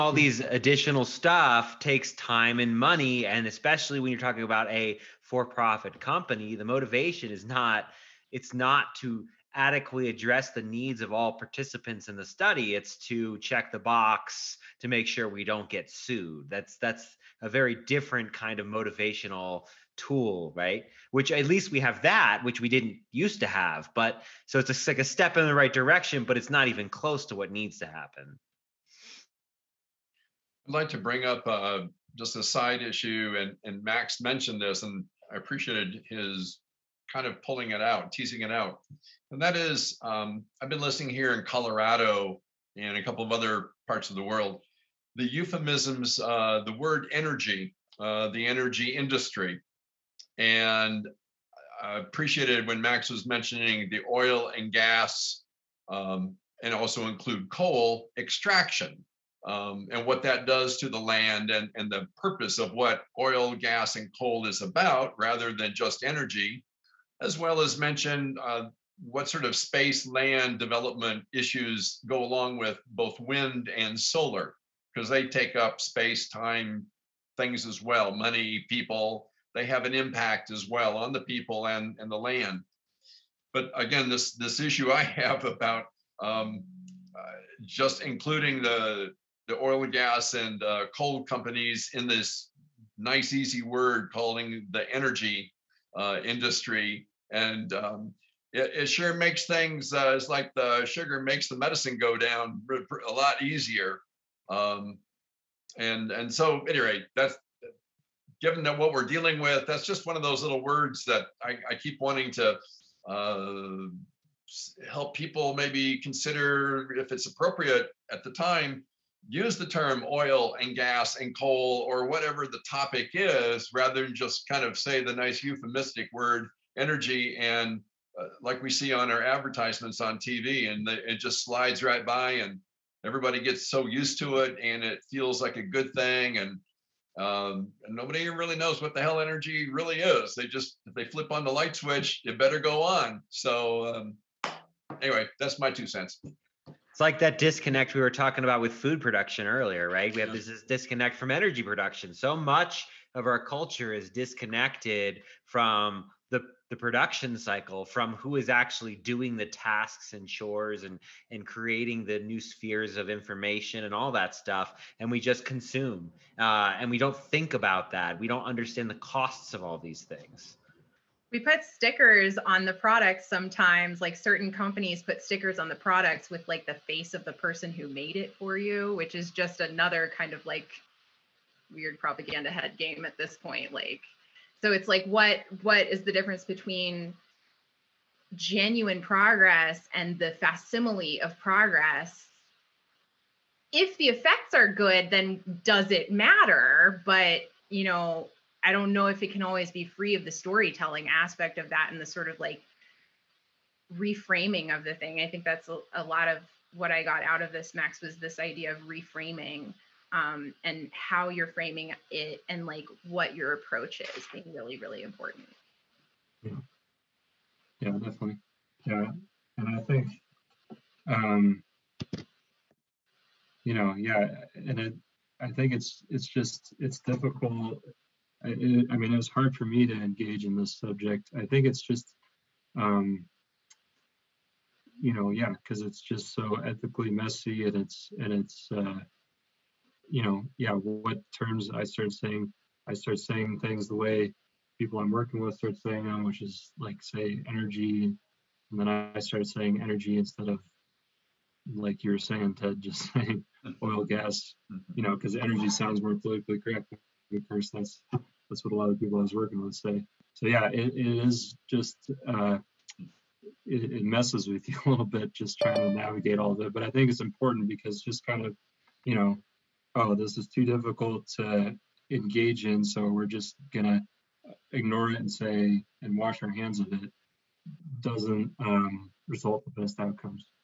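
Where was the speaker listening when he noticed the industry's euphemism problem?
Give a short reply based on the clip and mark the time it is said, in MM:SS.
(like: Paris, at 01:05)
Colorado, at 00:41.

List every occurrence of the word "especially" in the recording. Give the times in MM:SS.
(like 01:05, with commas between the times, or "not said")
00:03.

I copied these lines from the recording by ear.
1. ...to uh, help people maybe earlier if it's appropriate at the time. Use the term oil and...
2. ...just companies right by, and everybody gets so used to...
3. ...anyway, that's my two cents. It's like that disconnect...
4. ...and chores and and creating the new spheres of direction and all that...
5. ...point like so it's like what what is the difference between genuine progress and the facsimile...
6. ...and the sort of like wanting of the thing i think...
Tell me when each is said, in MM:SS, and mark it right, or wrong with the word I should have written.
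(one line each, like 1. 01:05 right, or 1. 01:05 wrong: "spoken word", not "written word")
1. 01:52 wrong: "consider", not "earlier"
2. 02:11 wrong: "slides", not "companies"
3. 02:25 right
4. 02:40 wrong: "information", not "direction"
5. 03:03 right
6. 03:21 wrong: "reframing", not "wanting".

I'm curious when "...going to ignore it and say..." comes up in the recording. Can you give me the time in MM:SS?
04:33.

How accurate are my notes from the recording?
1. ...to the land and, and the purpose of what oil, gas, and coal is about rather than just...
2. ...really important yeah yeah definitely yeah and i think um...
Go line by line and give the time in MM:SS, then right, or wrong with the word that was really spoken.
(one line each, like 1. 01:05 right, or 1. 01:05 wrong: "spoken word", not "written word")
1. 01:00 right
2. 03:34 right.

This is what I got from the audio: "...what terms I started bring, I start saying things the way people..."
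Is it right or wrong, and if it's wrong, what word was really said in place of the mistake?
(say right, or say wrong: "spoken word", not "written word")
wrong: "saying", not "bring".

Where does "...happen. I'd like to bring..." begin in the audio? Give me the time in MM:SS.
00:27.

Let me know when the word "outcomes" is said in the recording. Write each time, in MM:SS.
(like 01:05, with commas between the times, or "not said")
04:39.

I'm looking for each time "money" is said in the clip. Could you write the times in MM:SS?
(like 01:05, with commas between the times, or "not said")
00:02, 01:18.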